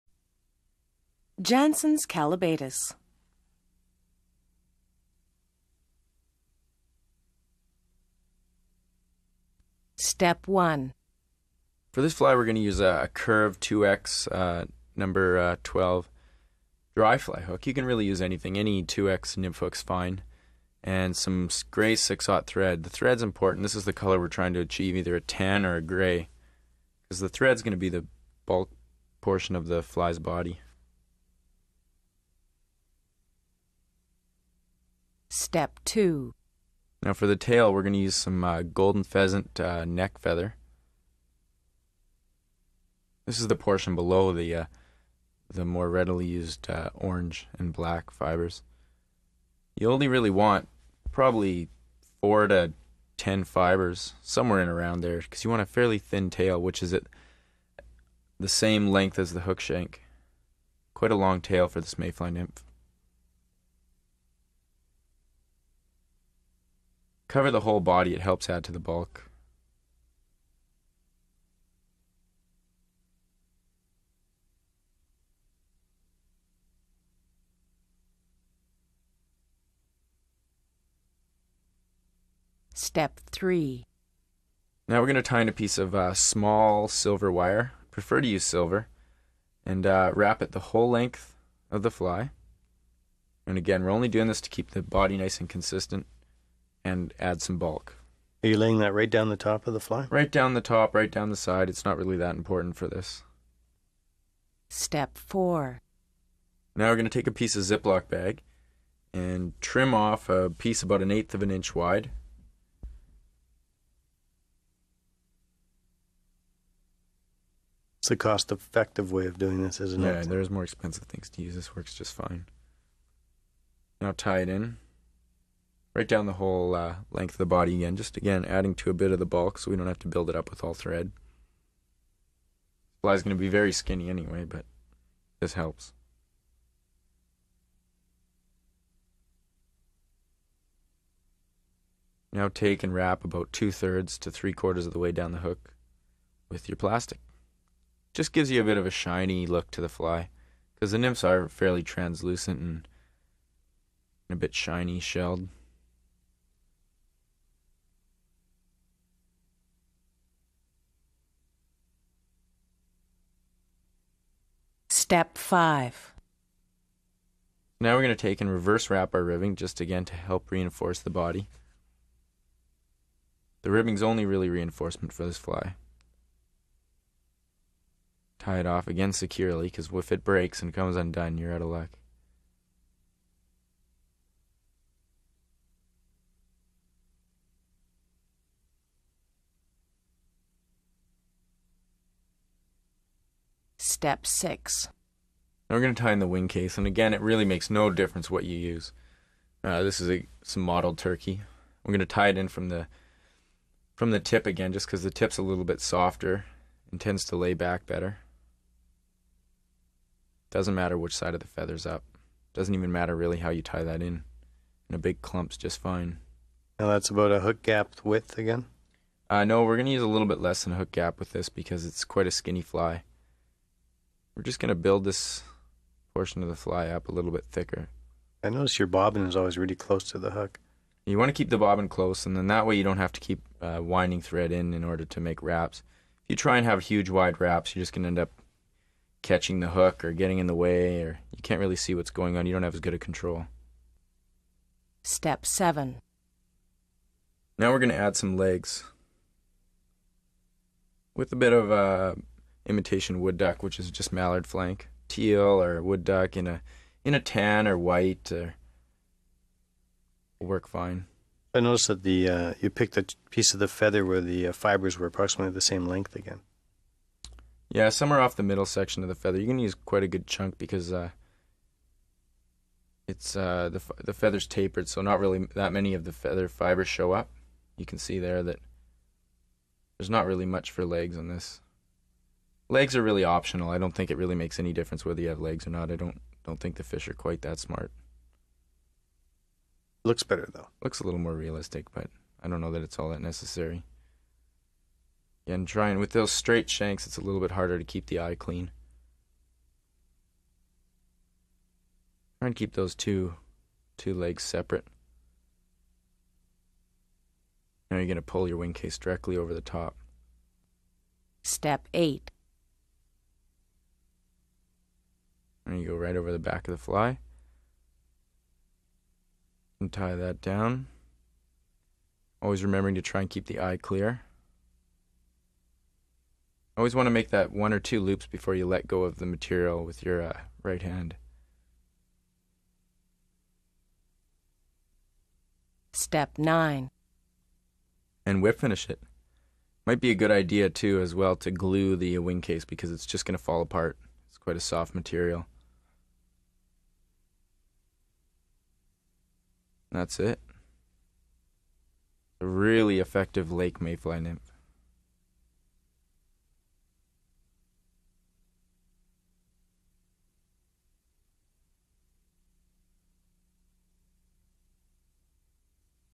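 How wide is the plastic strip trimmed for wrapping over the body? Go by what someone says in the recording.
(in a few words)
1/8 inch.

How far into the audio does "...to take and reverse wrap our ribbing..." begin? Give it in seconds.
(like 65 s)
168 s.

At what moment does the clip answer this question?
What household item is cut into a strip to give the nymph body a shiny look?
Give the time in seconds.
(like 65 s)
107 s.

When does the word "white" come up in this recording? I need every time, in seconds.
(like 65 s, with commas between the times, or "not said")
257 s.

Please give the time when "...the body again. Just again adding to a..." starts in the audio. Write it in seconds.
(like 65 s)
127 s.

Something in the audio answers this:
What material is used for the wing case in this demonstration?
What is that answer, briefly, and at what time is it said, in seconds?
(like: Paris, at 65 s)
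Mottled turkey, at 200 s.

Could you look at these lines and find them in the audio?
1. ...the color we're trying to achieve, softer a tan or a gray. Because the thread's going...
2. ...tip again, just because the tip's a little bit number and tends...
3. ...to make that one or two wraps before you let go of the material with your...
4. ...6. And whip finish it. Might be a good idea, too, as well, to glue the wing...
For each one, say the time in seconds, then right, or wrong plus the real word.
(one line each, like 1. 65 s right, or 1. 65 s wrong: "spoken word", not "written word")
1. 23 s wrong: "either", not "softer"
2. 204 s wrong: "softer", not "number"
3. 327 s wrong: "loops", not "wraps"
4. 336 s wrong: "9", not "6".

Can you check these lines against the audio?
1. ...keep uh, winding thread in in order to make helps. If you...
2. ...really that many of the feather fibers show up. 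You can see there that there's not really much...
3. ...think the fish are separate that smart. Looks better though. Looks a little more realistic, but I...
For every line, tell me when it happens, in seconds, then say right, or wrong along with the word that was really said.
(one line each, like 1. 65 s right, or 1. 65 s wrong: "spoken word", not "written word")
1. 233 s wrong: "wraps", not "helps"
2. 275 s right
3. 286 s wrong: "quite", not "separate".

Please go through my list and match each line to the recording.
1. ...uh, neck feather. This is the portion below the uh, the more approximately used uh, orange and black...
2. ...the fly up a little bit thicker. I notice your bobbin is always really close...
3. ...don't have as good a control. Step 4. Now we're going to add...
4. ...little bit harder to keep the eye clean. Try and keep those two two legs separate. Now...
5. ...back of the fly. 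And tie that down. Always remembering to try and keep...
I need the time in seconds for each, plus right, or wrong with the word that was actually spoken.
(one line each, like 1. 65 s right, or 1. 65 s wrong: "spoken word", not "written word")
1. 39 s wrong: "readily", not "approximately"
2. 226 s right
3. 242 s wrong: "7", not "4"
4. 297 s right
5. 316 s right.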